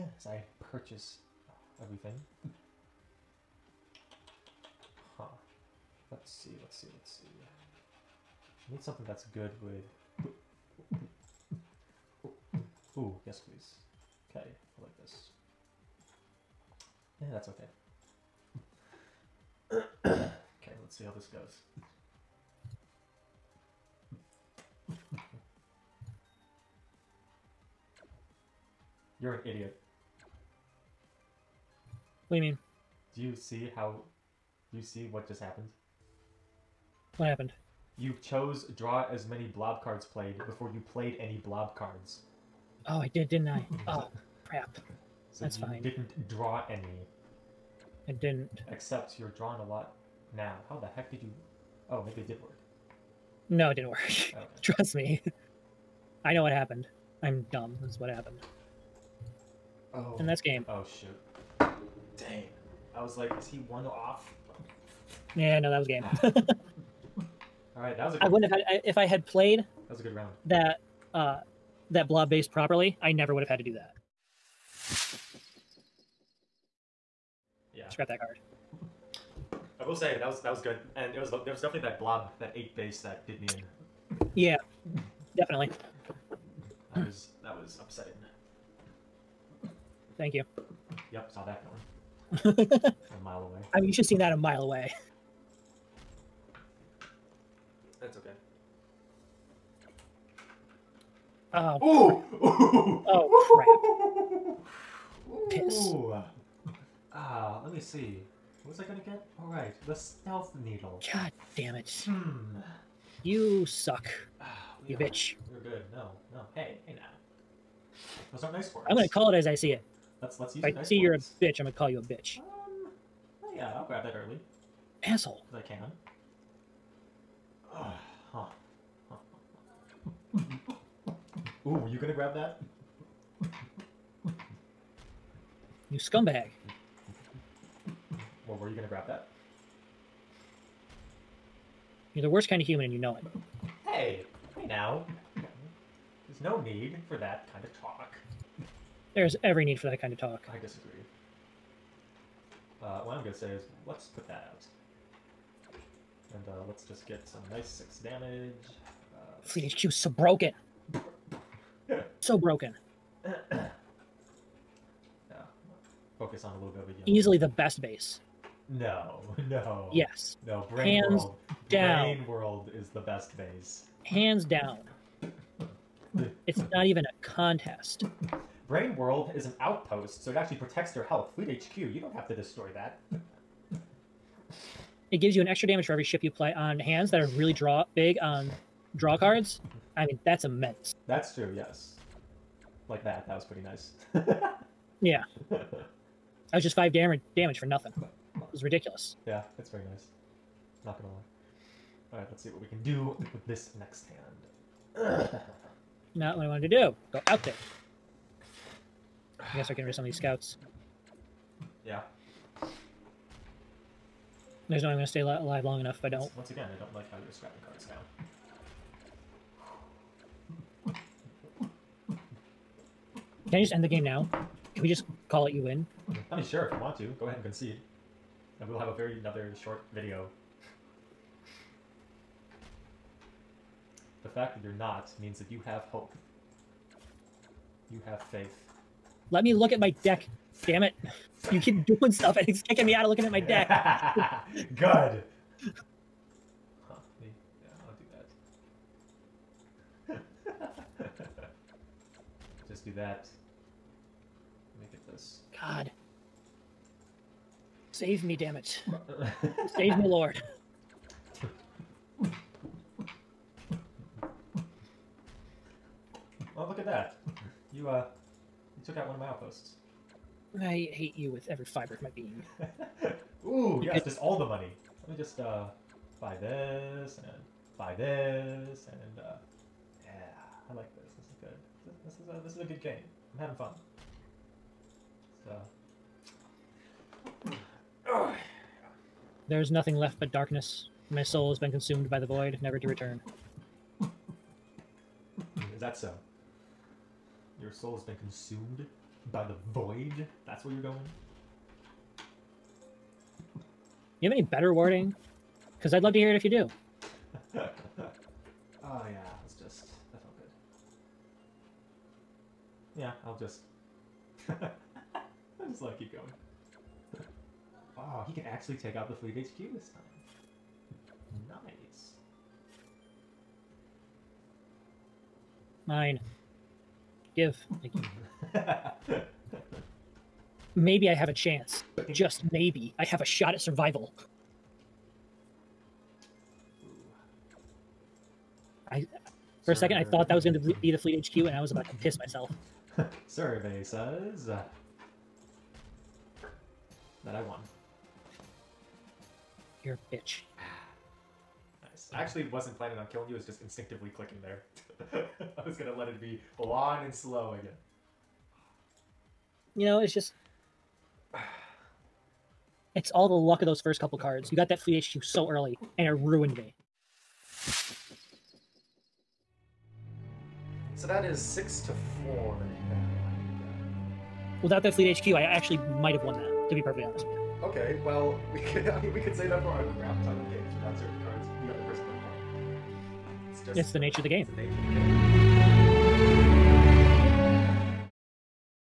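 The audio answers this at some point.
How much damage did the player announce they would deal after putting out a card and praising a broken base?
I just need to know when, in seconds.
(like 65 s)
157 s.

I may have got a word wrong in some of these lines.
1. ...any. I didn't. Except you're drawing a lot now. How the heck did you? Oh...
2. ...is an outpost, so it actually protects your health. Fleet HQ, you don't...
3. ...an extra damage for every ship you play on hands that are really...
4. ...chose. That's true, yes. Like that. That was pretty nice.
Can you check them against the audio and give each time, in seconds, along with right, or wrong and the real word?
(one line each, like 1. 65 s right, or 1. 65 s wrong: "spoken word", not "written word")
1. 46 s right
2. 179 s right
3. 185 s right
4. 190 s wrong: "immense", not "chose".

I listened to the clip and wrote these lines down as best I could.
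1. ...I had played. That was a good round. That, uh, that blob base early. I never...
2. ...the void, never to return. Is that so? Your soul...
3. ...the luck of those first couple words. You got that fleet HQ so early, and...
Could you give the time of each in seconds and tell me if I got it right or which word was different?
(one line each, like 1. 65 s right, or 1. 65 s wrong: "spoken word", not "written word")
1. 68 s wrong: "properly", not "early"
2. 292 s right
3. 363 s wrong: "cards", not "words".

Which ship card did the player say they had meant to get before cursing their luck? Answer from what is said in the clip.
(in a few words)
Stealth Needle.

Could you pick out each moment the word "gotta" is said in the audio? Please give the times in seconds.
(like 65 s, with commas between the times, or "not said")
209 s.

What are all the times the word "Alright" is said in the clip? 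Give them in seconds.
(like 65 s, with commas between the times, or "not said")
109 s, 202 s.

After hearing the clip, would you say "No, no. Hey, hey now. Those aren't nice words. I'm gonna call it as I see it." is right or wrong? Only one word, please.
right.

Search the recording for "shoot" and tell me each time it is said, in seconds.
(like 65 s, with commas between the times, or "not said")
60 s.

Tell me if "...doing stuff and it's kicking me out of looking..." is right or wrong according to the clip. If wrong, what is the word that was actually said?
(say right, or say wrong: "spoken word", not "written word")
right.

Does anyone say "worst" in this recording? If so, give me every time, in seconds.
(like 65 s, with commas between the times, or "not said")
142 s.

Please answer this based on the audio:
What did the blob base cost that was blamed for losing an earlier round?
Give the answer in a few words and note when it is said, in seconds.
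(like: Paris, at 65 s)
8, at 82 s.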